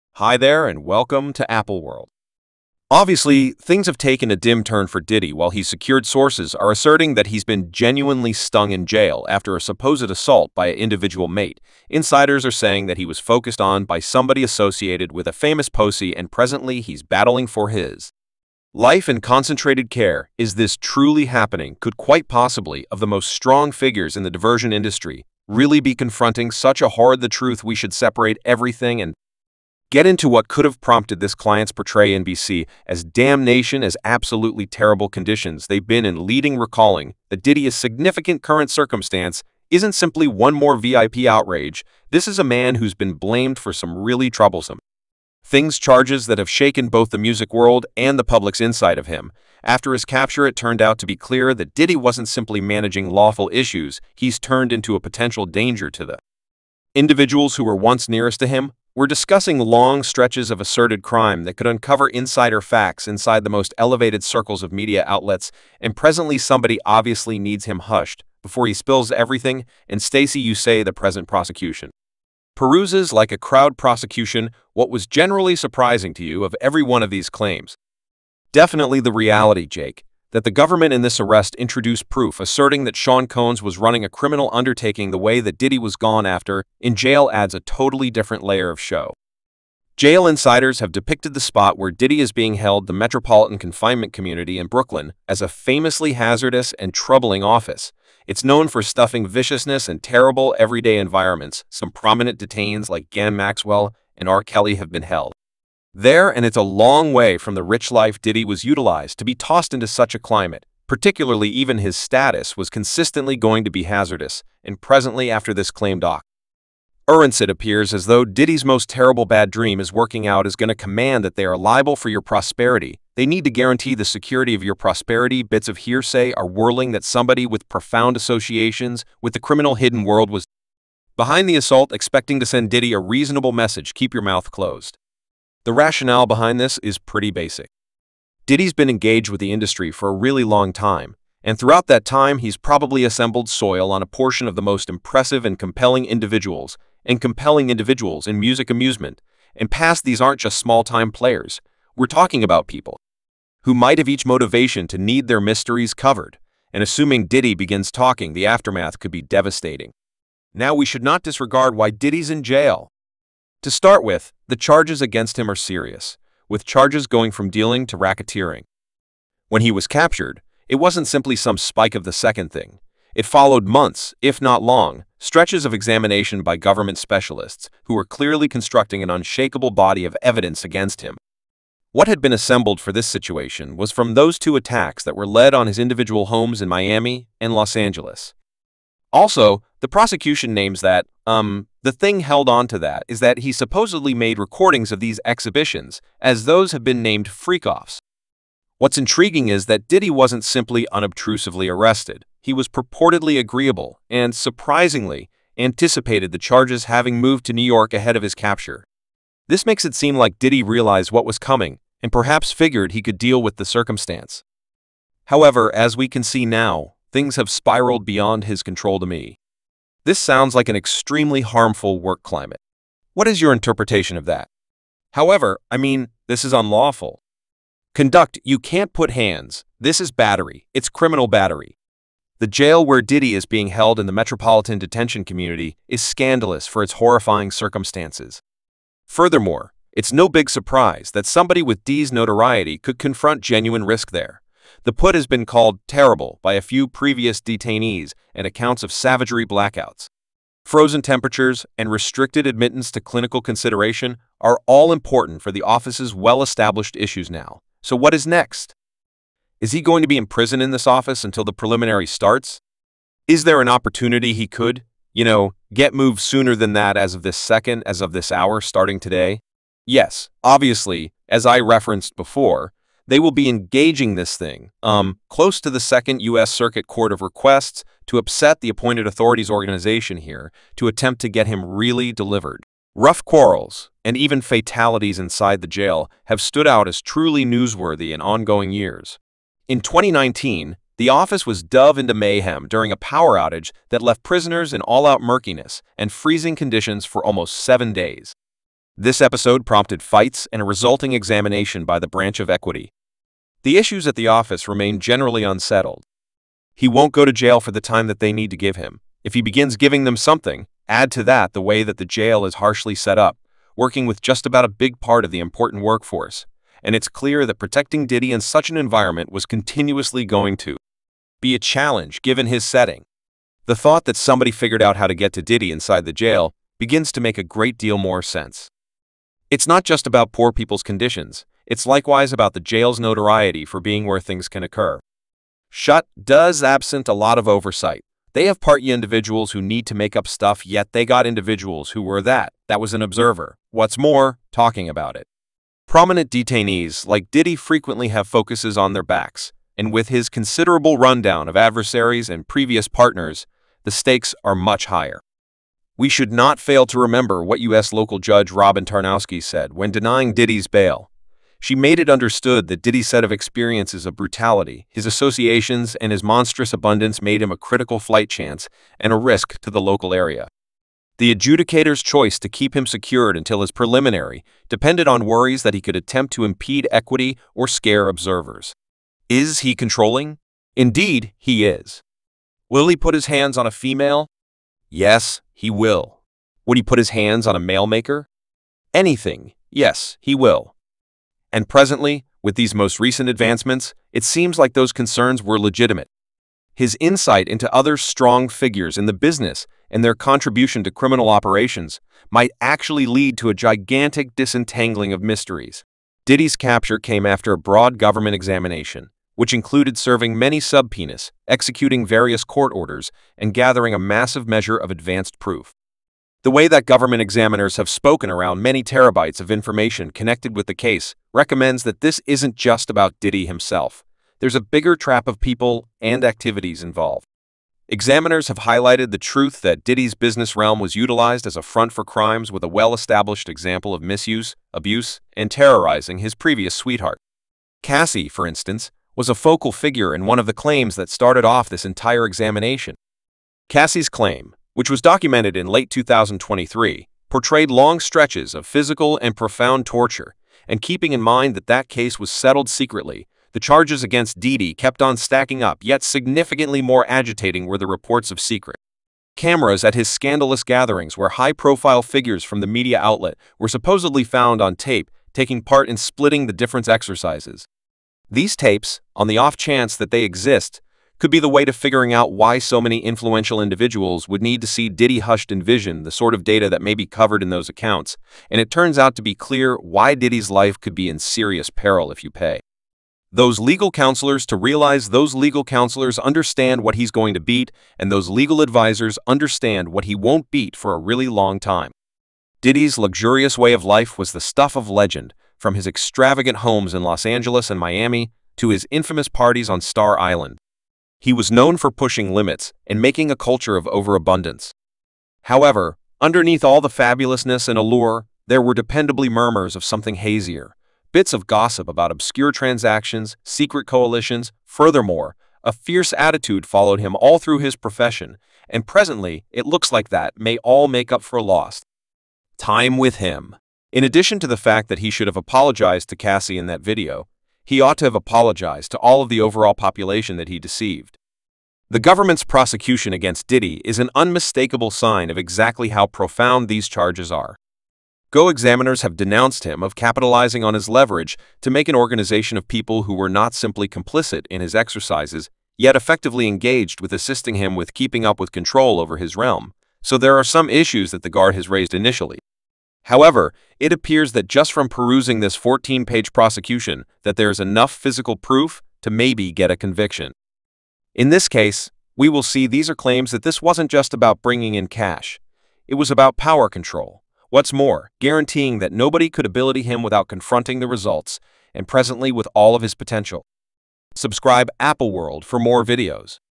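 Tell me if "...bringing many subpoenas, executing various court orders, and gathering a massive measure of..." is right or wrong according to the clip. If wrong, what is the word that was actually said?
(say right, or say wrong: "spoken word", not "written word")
wrong: "serving", not "bringing".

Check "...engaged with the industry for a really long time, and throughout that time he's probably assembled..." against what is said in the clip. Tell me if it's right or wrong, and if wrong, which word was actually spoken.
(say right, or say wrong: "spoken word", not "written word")
right.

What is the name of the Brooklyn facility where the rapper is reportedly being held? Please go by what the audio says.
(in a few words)
Metropolitan Confinement Community.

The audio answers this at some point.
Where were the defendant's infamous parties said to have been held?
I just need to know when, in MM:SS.
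08:19.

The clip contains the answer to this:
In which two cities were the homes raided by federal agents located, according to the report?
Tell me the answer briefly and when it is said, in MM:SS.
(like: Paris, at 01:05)
Miami and Los Angeles, at 03:06.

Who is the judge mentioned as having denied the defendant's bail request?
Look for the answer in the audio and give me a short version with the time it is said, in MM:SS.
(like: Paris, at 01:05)
Robyn Tarnofsky, at 05:58.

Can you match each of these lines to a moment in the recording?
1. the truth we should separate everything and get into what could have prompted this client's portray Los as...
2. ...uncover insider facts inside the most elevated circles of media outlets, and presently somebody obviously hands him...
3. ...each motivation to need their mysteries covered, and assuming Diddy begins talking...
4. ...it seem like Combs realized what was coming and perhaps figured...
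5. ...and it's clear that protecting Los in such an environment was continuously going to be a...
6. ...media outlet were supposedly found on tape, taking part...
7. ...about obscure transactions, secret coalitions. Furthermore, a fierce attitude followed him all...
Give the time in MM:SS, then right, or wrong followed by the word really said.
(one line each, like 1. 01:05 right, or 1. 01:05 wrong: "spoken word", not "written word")
1. 00:27 wrong: "NBC", not "Los"
2. 01:01 wrong: "needs", not "hands"
3. 02:34 right
4. 03:29 wrong: "Diddy", not "Combs"
5. 05:16 wrong: "Diddy", not "Los"
6. 07:42 right
7. 08:31 right.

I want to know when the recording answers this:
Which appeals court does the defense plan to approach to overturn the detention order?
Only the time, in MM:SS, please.
04:35.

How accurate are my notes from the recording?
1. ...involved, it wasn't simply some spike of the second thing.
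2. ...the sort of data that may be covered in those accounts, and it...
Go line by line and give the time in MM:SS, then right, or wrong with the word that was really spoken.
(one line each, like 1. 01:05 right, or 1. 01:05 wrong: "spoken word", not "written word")
1. 02:49 wrong: "captured", not "involved"
2. 07:56 right.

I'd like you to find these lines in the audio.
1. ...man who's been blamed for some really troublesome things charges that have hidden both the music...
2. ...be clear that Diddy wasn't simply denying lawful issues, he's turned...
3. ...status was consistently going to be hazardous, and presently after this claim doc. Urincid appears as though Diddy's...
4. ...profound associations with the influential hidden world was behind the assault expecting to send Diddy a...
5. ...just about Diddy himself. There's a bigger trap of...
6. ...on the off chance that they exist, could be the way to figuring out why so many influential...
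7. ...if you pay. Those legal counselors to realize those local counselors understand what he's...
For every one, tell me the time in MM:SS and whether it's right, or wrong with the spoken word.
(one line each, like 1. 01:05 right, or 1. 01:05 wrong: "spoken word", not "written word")
1. 00:42 wrong: "shaken", not "hidden"
2. 00:51 wrong: "managing", not "denying"
3. 01:51 right
4. 02:07 wrong: "criminal", not "influential"
5. 07:02 right
6. 07:49 right
7. 08:02 wrong: "legal", not "local".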